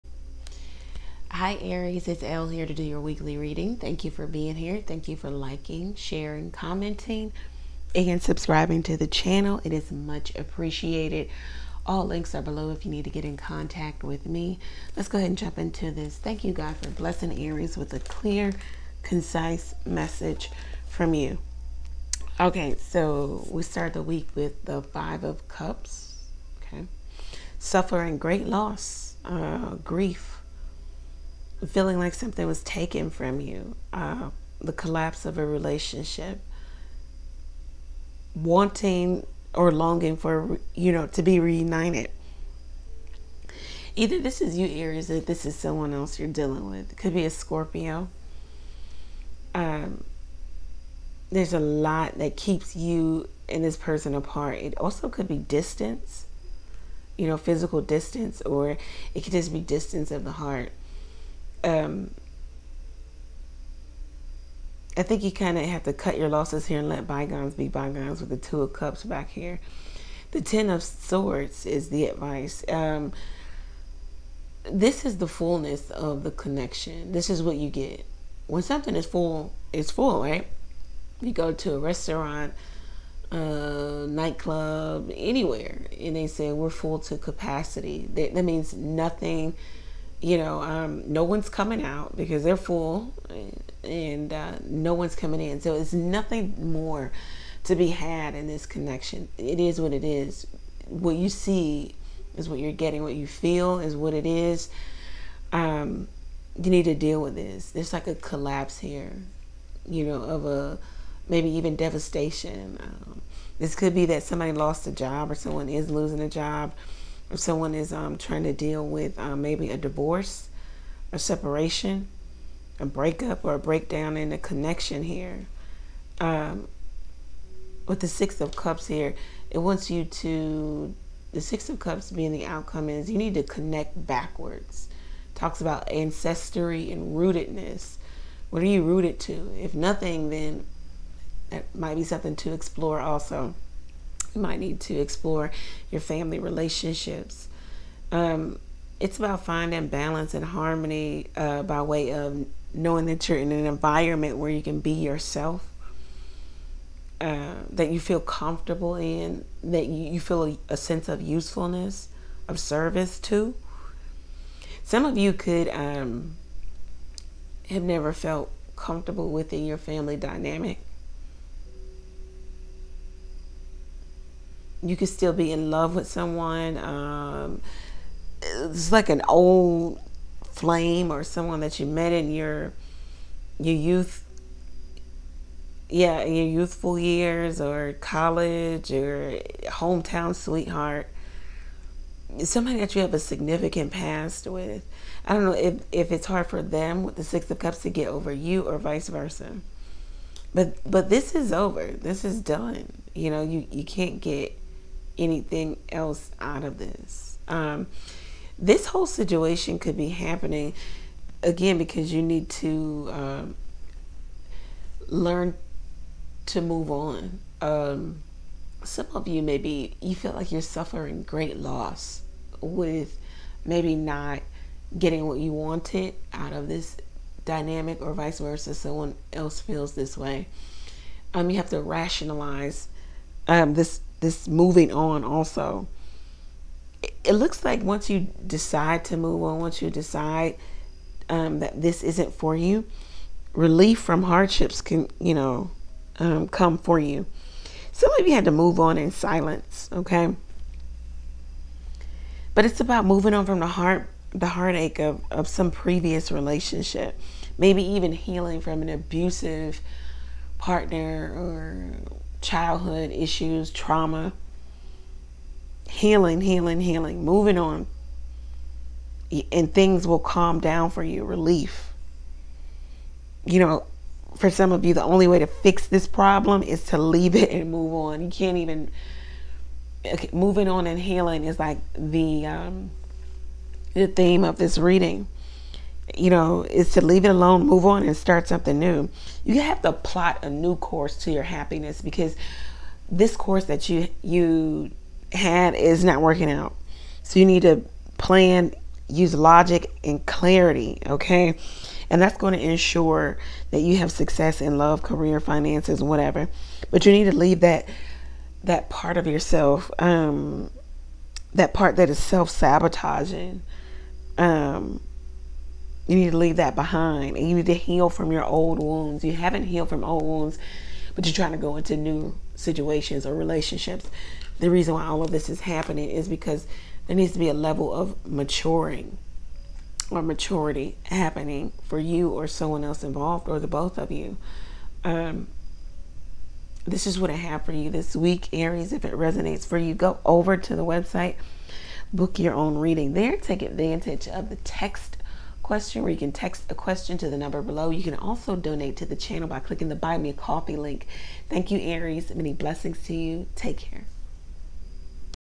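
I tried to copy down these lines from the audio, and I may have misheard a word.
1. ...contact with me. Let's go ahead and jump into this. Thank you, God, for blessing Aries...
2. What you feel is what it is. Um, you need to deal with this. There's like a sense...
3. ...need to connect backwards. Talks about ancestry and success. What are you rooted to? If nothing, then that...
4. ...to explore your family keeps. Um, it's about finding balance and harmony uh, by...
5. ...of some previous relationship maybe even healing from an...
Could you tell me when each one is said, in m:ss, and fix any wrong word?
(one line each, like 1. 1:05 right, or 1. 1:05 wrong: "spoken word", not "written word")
1. 0:13 right
2. 1:43 wrong: "collapse", not "sense"
3. 2:13 wrong: "rootedness", not "success"
4. 2:24 wrong: "relationships", not "keeps"
5. 4:15 right.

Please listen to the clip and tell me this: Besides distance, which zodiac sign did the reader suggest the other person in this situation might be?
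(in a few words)
Scorpio.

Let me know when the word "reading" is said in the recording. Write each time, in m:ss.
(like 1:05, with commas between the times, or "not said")
0:03, 4:44, 5:42.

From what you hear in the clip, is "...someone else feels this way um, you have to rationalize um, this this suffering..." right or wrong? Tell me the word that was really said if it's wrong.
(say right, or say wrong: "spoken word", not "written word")
wrong: "moving", not "suffering".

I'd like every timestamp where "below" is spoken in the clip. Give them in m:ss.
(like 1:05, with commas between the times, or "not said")
0:12, 5:47.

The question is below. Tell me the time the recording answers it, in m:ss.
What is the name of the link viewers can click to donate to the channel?
5:49.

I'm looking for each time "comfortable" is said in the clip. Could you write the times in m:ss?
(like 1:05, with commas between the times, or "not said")
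2:38, 2:48.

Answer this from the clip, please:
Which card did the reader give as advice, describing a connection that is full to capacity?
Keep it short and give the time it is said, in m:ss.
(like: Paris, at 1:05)
Ten of Swords, at 1:10.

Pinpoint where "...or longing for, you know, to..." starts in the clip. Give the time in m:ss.
0:39.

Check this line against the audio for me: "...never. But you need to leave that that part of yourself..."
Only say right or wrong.
wrong.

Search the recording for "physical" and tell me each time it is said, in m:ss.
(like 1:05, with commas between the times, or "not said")
0:57.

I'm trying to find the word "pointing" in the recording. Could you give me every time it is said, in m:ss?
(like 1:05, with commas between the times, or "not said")
not said.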